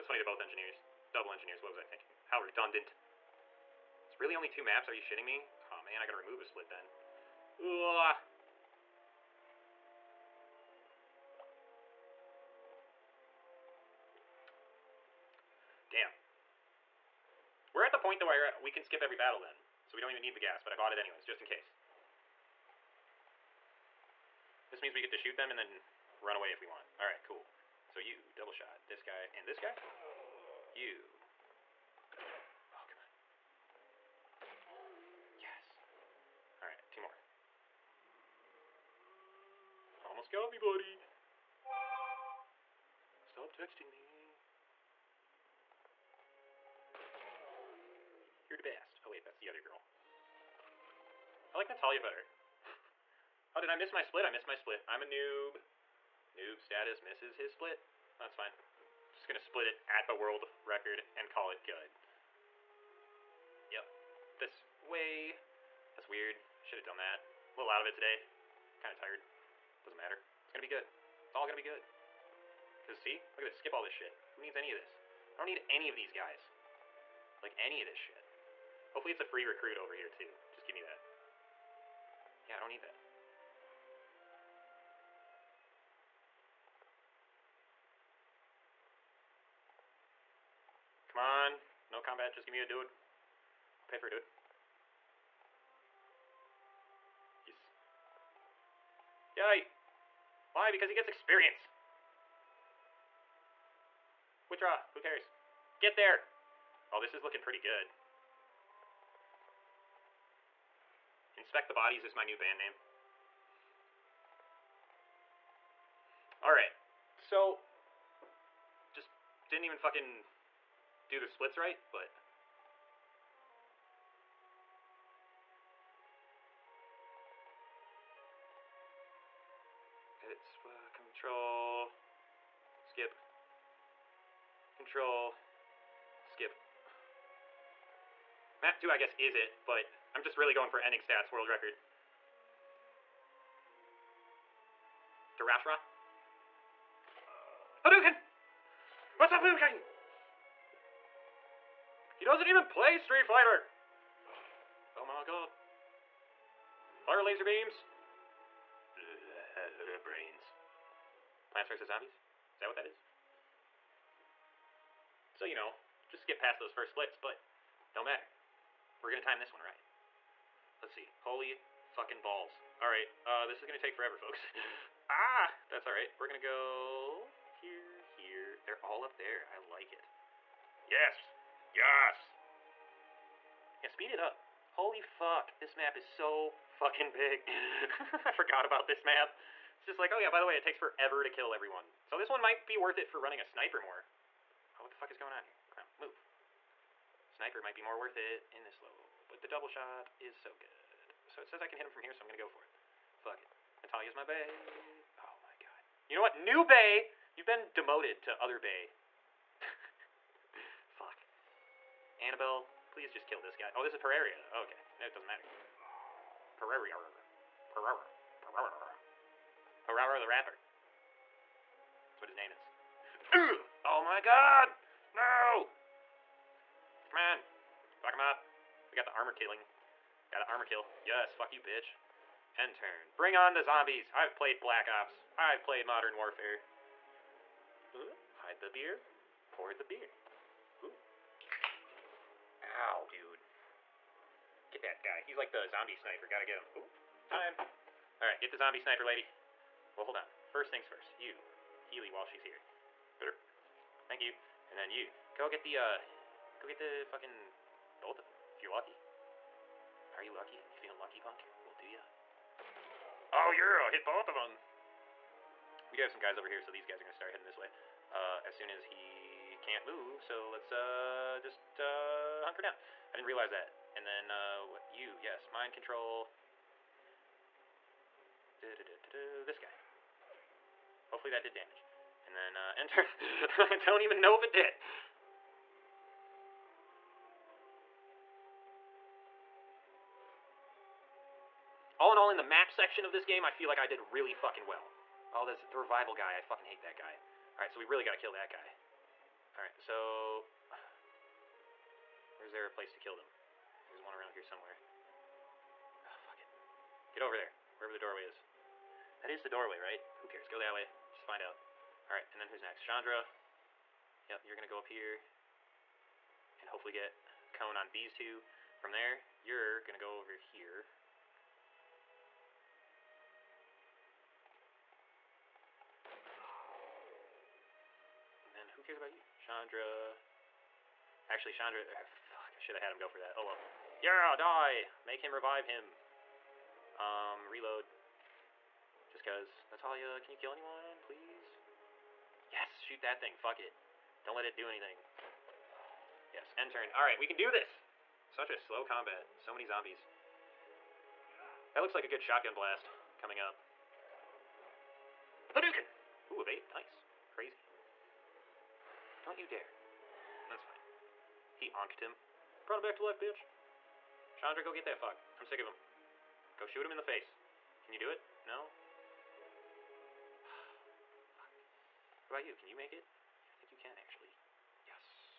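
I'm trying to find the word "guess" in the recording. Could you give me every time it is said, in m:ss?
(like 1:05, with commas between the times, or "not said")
2:18.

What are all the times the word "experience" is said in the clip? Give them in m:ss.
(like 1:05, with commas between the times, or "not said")
1:41.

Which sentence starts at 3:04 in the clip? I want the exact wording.
Holy fuck, this map is so fucking big.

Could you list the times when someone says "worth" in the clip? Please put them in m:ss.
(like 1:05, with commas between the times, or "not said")
3:12, 3:17.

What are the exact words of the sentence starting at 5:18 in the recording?
From there, you're going to go over here.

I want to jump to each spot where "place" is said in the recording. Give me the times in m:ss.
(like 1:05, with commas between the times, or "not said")
5:02.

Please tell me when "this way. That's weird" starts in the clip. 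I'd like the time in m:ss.
1:04.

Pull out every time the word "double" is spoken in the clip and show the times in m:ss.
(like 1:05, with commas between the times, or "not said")
0:01, 0:28, 3:19.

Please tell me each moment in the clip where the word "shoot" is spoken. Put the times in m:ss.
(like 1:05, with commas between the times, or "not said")
0:25, 5:42, 6:06.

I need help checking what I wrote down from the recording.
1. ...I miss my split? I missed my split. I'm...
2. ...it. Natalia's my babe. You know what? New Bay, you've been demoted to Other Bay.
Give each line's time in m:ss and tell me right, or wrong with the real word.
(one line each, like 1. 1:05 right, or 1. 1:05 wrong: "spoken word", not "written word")
1. 0:53 right
2. 3:23 right.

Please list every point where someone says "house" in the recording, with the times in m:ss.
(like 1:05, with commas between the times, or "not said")
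not said.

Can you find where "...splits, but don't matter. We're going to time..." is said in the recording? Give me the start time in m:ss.
2:46.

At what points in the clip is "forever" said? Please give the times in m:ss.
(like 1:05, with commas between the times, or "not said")
2:53, 3:10.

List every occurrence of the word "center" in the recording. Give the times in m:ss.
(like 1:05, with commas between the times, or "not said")
not said.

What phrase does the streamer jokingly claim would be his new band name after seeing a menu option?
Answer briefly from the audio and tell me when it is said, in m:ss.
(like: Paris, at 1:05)
Inspect the Bodies, at 1:51.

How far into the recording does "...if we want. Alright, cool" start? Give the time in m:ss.
0:26.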